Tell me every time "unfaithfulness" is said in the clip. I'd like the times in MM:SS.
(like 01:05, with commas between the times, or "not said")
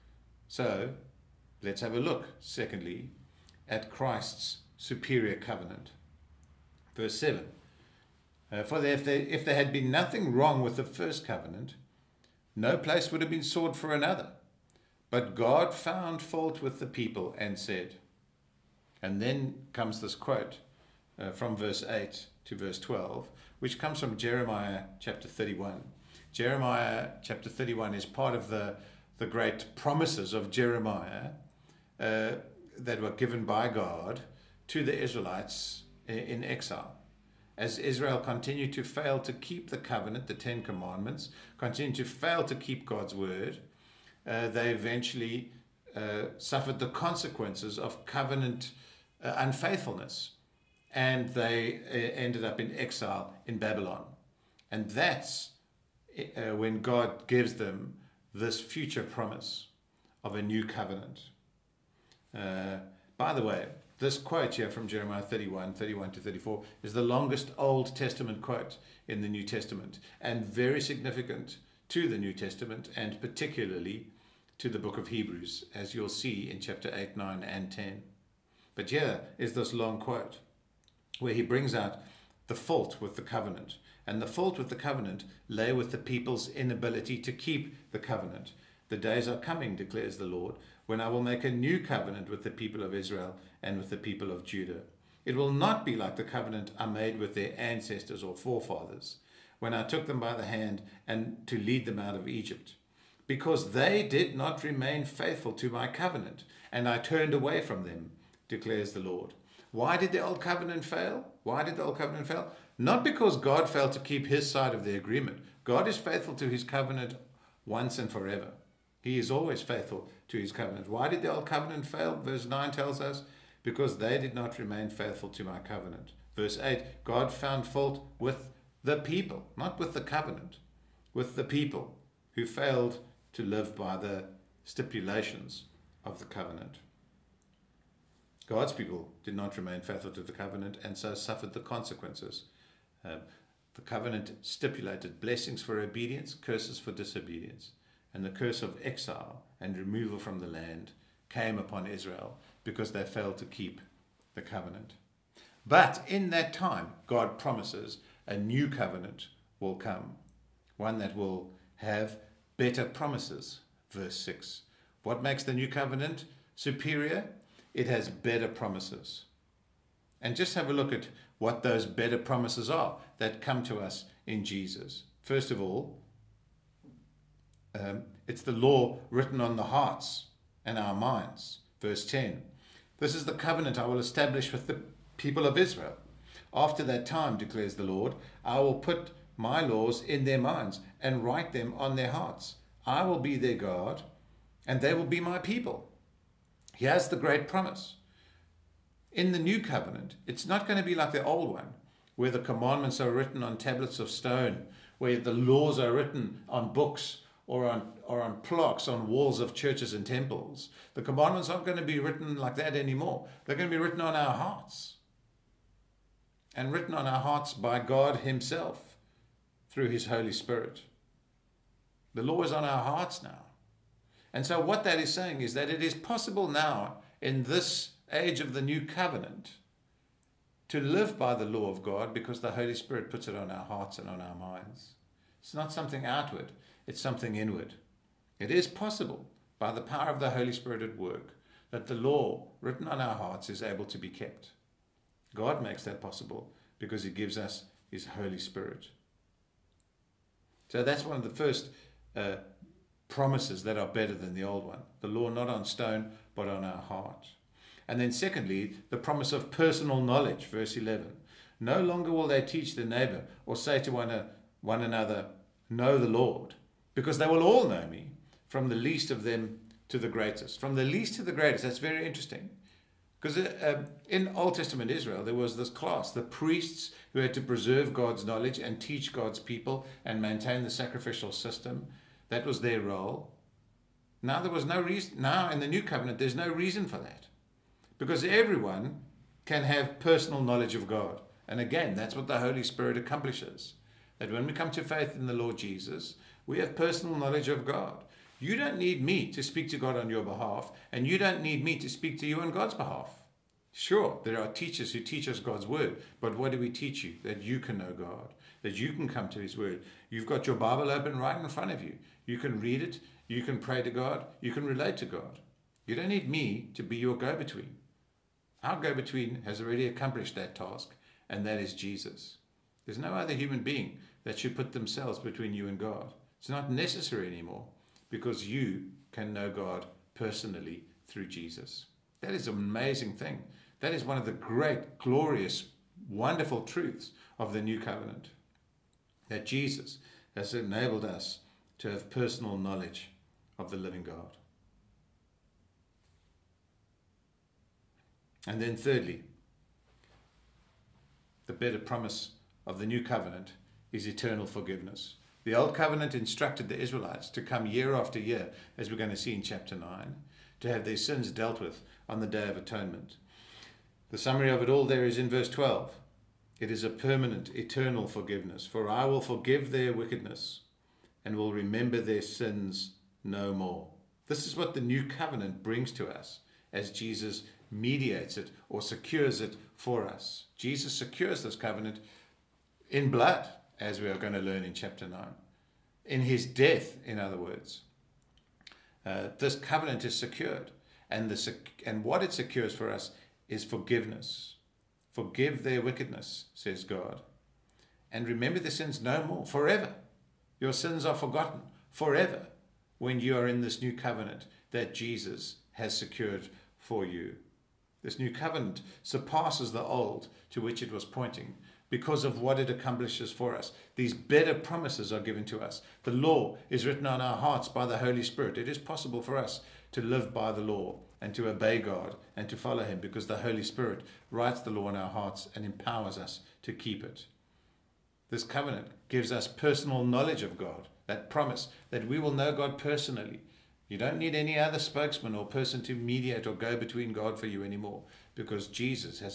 00:49.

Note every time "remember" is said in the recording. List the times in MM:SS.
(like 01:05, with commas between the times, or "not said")
06:11, 06:38.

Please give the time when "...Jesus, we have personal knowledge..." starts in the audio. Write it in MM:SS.
04:55.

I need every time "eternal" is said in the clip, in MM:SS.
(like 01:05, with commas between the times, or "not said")
05:54, 06:07.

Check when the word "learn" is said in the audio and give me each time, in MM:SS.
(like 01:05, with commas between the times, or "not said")
06:24.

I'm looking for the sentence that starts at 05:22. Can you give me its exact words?
There's no other human being that should put themselves between you and God.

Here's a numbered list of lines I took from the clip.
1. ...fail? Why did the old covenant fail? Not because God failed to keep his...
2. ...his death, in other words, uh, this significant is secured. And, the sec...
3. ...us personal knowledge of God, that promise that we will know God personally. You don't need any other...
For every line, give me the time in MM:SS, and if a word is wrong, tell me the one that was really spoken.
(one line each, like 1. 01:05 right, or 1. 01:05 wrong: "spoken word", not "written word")
1. 01:50 right
2. 06:26 wrong: "covenant", not "significant"
3. 07:09 right.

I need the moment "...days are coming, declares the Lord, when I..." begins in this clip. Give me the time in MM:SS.
01:28.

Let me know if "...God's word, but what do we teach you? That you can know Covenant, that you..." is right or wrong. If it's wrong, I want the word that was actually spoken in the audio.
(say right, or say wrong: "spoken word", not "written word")
wrong: "God", not "Covenant".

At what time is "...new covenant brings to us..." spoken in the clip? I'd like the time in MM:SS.
06:14.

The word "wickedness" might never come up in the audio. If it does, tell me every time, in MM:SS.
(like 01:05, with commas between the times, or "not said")
06:09, 06:35.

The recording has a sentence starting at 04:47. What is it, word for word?
Because everyone can have personal knowledge of God.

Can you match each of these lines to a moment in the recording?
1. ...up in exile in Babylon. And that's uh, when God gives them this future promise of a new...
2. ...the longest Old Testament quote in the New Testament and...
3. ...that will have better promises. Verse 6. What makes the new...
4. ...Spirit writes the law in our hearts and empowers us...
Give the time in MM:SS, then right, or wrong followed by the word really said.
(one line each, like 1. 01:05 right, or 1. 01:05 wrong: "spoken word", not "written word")
1. 00:52 right
2. 01:06 right
3. 02:40 right
4. 07:03 right.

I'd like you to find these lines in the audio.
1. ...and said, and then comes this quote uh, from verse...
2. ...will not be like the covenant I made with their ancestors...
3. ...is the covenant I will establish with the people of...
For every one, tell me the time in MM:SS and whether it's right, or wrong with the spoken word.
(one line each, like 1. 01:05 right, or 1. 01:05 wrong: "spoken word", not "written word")
1. 00:17 right
2. 01:35 right
3. 03:03 right.